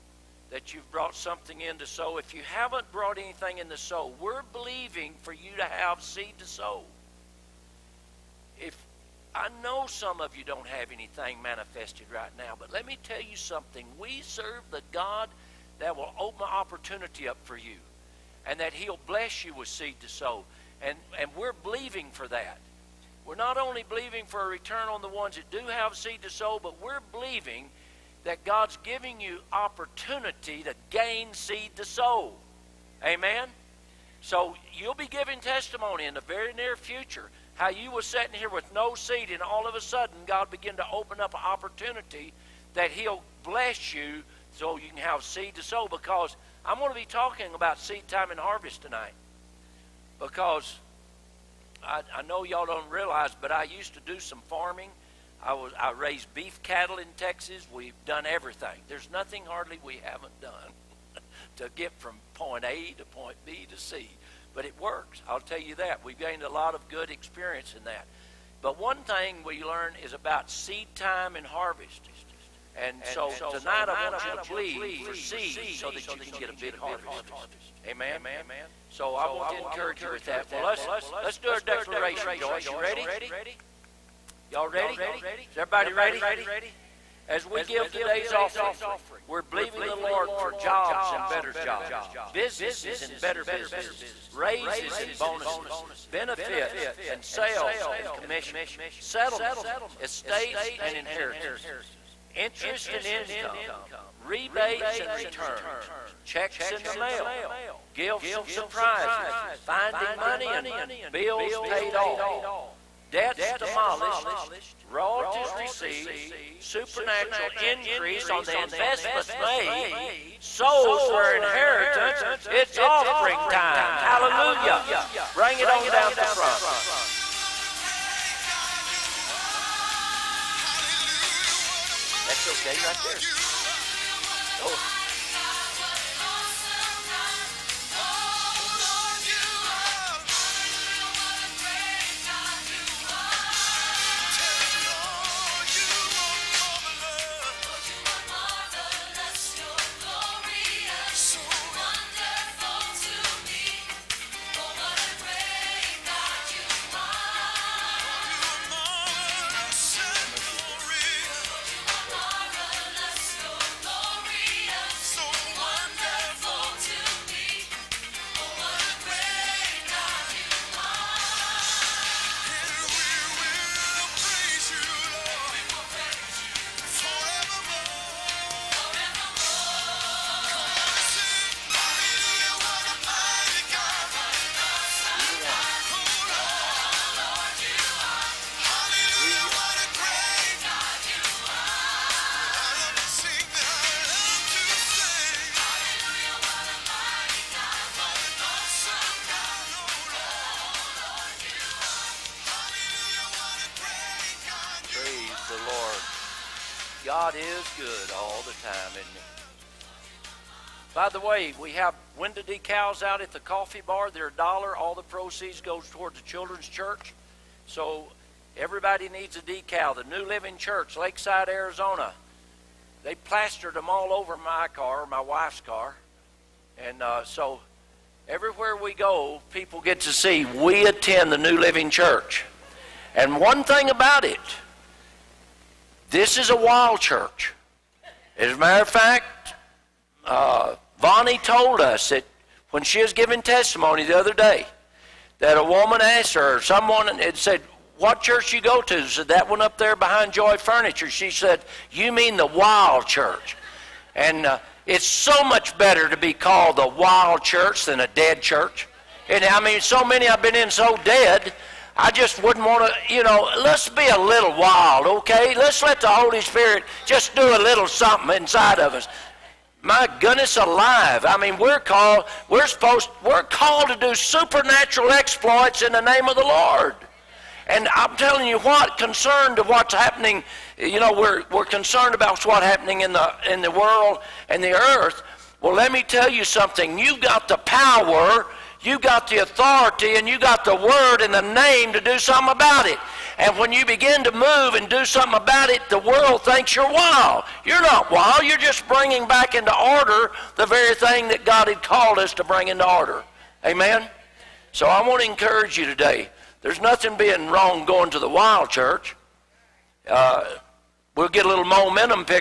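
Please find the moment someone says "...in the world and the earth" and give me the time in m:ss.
4:43.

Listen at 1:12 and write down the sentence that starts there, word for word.
And so tonight I want you to believe for seed so that you can get a big harvest.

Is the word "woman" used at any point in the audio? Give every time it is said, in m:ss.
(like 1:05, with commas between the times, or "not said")
4:05.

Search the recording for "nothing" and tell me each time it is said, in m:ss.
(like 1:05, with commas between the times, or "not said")
0:59, 5:06.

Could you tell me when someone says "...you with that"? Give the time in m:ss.
1:20.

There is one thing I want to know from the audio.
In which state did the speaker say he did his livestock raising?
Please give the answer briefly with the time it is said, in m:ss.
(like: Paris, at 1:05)
Texas, at 0:57.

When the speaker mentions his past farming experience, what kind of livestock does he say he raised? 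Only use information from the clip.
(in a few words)
beef cattle.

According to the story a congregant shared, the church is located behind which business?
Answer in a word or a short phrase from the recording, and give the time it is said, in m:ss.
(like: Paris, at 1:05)
Joy Furniture, at 4:10.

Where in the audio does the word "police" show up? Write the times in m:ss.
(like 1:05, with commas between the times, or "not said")
not said.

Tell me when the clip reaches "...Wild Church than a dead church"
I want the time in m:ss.
4:16.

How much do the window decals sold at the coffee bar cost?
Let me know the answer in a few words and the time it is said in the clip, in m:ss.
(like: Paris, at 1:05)
$1, at 3:34.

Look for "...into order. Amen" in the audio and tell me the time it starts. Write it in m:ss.
5:02.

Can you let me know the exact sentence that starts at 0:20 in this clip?
And, and we're believing for that.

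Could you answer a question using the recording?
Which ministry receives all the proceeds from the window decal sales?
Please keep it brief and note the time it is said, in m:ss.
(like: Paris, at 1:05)
children's church, at 3:36.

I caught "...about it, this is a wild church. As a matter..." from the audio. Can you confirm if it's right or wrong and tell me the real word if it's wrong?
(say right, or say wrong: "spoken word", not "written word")
right.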